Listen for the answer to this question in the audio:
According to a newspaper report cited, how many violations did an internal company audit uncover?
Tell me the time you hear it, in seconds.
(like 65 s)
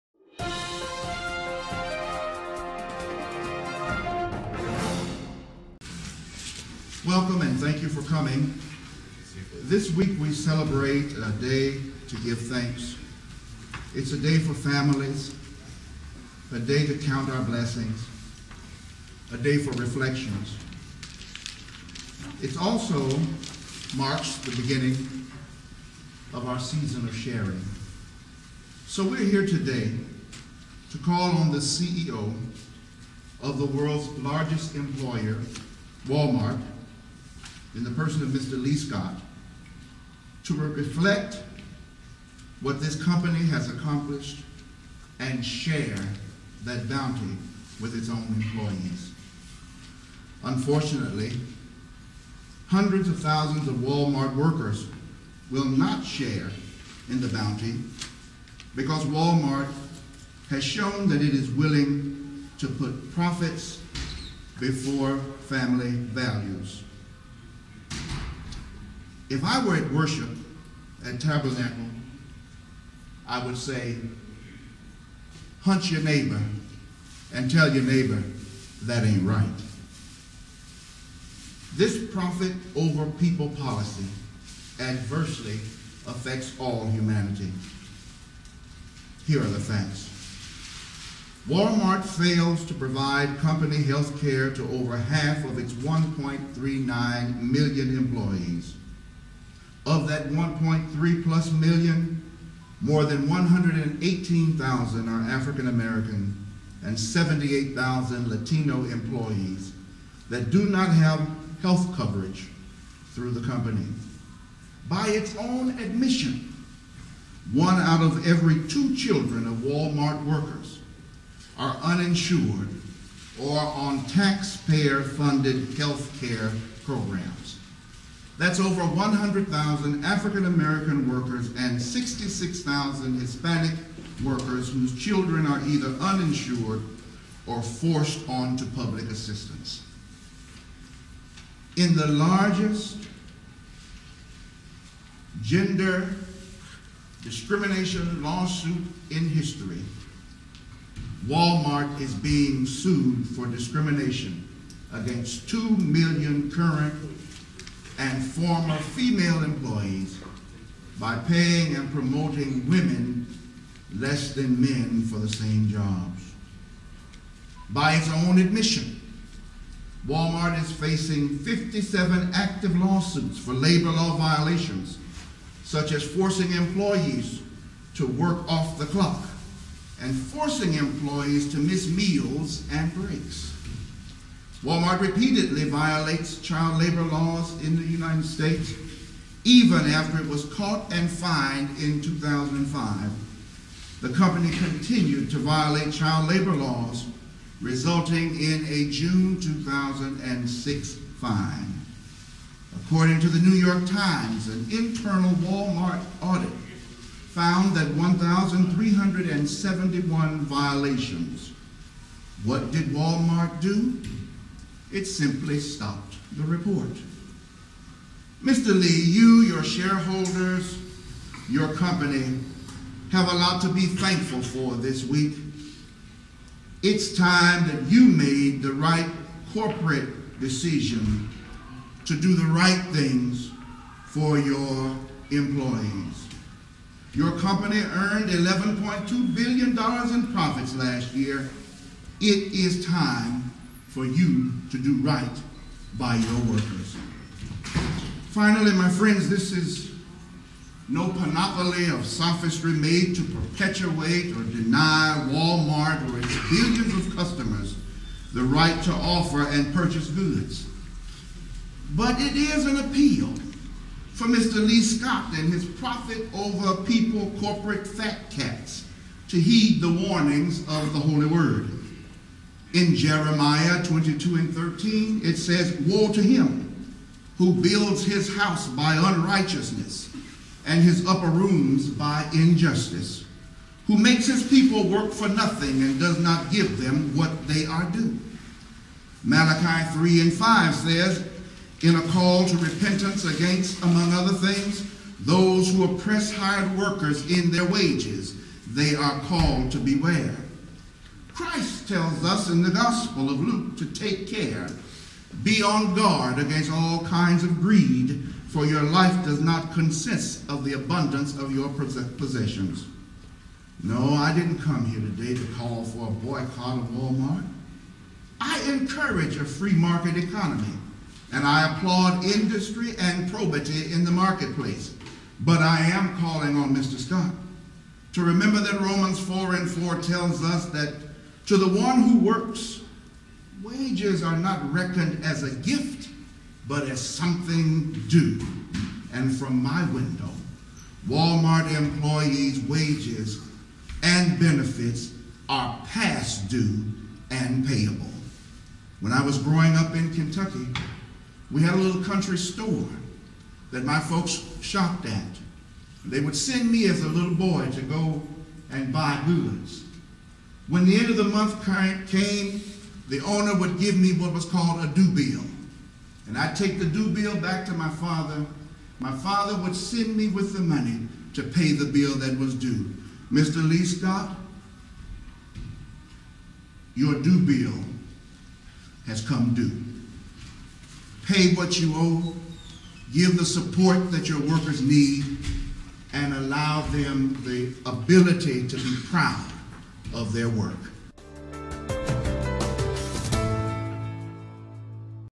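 207 s.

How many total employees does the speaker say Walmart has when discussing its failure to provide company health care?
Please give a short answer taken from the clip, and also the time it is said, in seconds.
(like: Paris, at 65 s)
1.39 million, at 95 s.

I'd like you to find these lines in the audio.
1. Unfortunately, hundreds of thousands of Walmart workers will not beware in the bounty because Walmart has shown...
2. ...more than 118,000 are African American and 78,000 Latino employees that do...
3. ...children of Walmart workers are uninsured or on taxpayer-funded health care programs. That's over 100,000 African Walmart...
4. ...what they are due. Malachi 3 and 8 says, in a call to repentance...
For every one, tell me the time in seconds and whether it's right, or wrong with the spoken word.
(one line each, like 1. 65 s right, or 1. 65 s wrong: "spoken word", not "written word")
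1. 50 s wrong: "share", not "beware"
2. 102 s right
3. 118 s wrong: "American", not "Walmart"
4. 287 s wrong: "5", not "8".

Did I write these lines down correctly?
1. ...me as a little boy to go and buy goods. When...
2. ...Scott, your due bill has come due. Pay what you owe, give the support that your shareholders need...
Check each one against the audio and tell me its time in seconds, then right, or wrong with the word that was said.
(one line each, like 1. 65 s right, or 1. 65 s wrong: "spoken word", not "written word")
1. 356 s right
2. 373 s wrong: "workers", not "shareholders".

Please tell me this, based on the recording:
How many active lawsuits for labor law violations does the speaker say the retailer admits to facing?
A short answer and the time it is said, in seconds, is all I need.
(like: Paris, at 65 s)
57, at 171 s.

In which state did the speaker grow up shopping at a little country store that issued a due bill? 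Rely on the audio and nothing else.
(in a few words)
Kentucky.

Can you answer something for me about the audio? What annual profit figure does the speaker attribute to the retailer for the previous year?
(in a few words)
$11.2 billion.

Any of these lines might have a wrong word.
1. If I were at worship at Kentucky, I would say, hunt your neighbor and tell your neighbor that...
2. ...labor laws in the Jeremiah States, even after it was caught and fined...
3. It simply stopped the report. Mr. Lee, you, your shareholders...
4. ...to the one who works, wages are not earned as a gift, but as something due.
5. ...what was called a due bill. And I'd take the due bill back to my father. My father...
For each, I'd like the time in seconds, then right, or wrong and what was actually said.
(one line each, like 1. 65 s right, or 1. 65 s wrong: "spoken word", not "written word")
1. 69 s wrong: "Tabernacle", not "Kentucky"
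2. 186 s wrong: "United", not "Jeremiah"
3. 214 s right
4. 331 s wrong: "reckoned", not "earned"
5. 364 s right.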